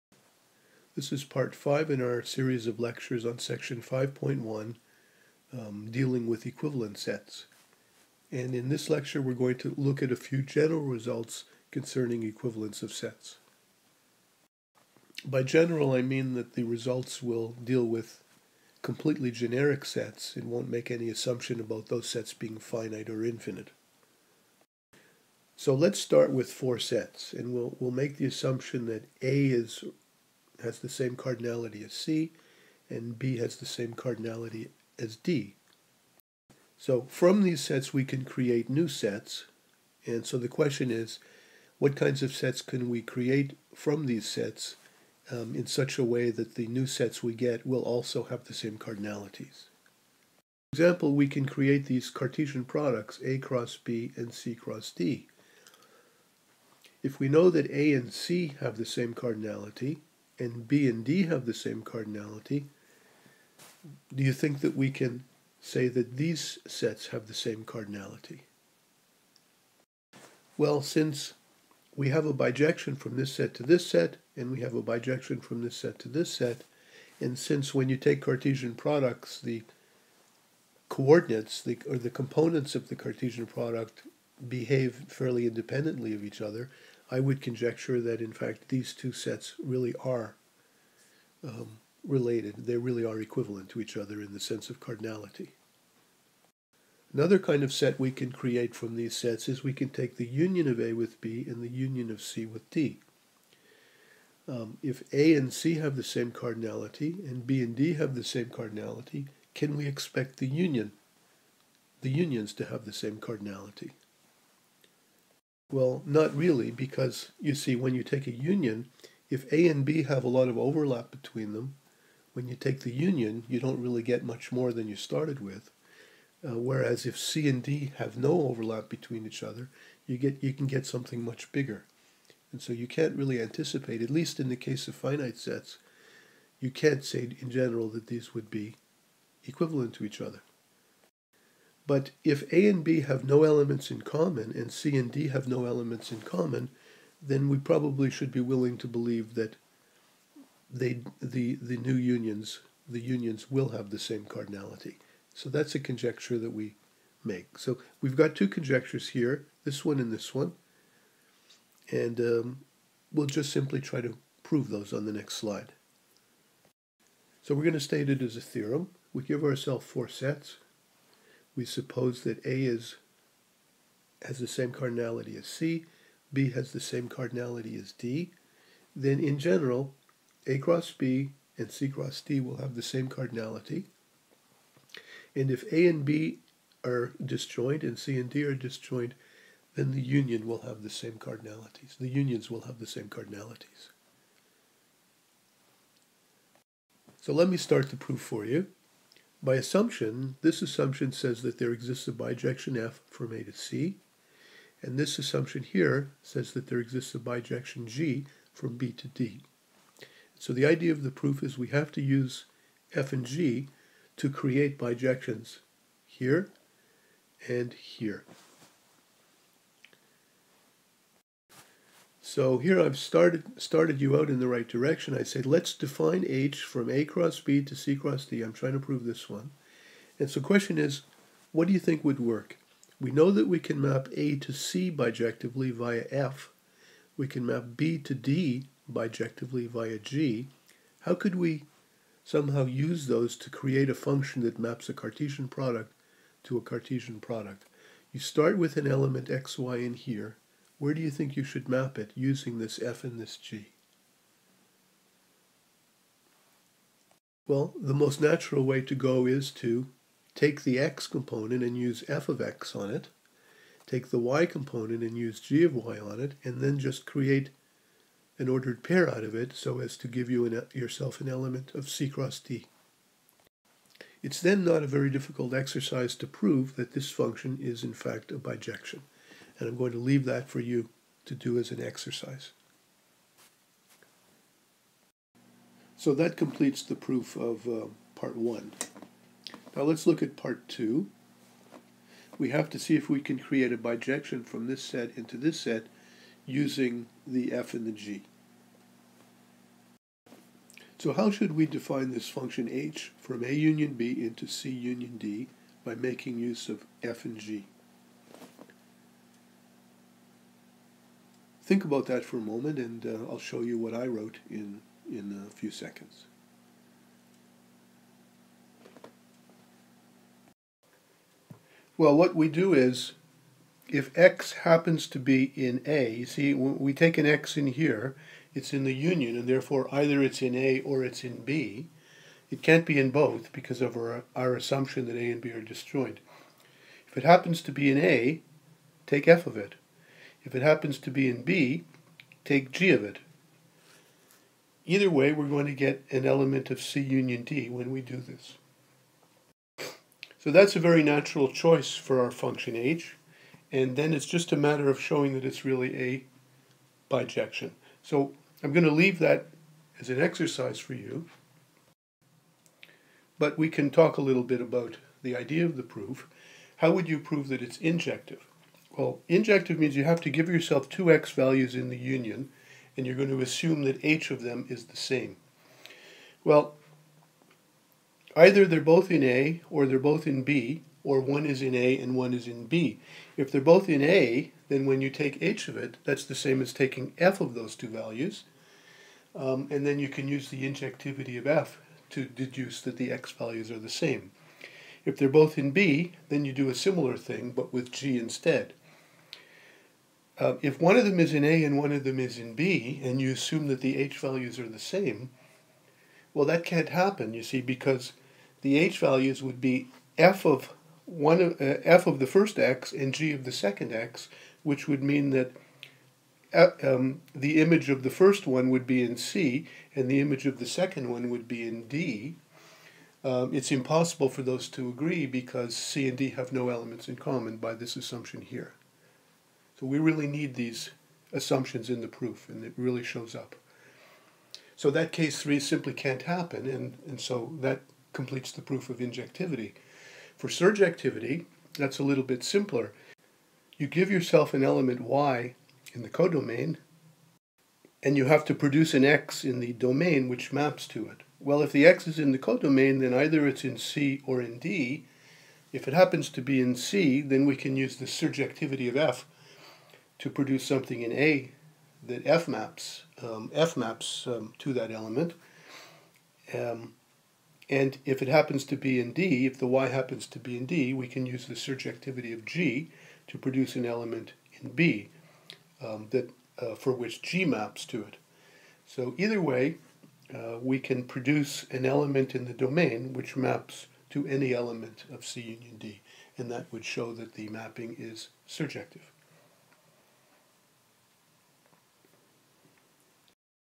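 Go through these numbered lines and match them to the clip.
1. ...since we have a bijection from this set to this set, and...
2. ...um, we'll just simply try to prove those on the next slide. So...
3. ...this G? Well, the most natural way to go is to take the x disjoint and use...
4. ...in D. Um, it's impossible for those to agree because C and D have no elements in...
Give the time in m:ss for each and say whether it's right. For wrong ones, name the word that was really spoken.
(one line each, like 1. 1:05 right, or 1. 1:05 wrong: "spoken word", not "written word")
1. 1:10 right
2. 2:42 right
3. 4:13 wrong: "component", not "disjoint"
4. 7:01 right.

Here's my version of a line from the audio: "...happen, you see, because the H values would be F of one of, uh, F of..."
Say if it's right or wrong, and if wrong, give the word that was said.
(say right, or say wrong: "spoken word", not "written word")
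right.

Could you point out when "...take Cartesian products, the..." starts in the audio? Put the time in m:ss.
1:17.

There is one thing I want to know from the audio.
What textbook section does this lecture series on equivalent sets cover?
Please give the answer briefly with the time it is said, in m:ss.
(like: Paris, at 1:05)
5.1, at 0:03.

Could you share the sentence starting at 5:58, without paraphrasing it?
So I'm going to leave that as an exercise for you.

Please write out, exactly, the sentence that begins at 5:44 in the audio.
Either way, we're going to get an element of C union D when we do this.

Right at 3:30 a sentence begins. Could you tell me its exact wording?
So the idea of the proof is we have to use F and G to create bijections here and here.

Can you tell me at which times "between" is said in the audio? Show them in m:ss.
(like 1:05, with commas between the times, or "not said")
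2:01, 2:08.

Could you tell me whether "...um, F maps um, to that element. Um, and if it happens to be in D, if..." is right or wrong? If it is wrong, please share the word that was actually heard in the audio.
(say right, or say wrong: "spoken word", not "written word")
right.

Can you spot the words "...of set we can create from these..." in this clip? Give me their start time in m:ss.
1:37.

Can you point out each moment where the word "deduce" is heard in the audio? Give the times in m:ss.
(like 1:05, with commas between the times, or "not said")
6:32.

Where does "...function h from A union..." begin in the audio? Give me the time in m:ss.
5:02.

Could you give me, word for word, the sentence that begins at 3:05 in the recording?
And if A and B are disjoint and C and D are disjoint, then the union will have the same cardinalities.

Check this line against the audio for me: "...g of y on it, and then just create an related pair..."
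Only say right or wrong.
wrong.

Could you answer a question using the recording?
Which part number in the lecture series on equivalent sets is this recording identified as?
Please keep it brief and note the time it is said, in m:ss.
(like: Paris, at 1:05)
5, at 0:01.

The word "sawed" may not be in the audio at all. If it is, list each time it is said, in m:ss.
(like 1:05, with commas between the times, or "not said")
not said.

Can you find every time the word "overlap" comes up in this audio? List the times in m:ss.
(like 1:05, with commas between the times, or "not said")
2:00, 2:08.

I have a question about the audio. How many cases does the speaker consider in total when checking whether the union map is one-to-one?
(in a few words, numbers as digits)
3.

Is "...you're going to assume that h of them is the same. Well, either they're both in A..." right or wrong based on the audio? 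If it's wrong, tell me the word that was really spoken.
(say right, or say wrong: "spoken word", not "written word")
right.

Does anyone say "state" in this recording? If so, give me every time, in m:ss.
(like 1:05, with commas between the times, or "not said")
2:47.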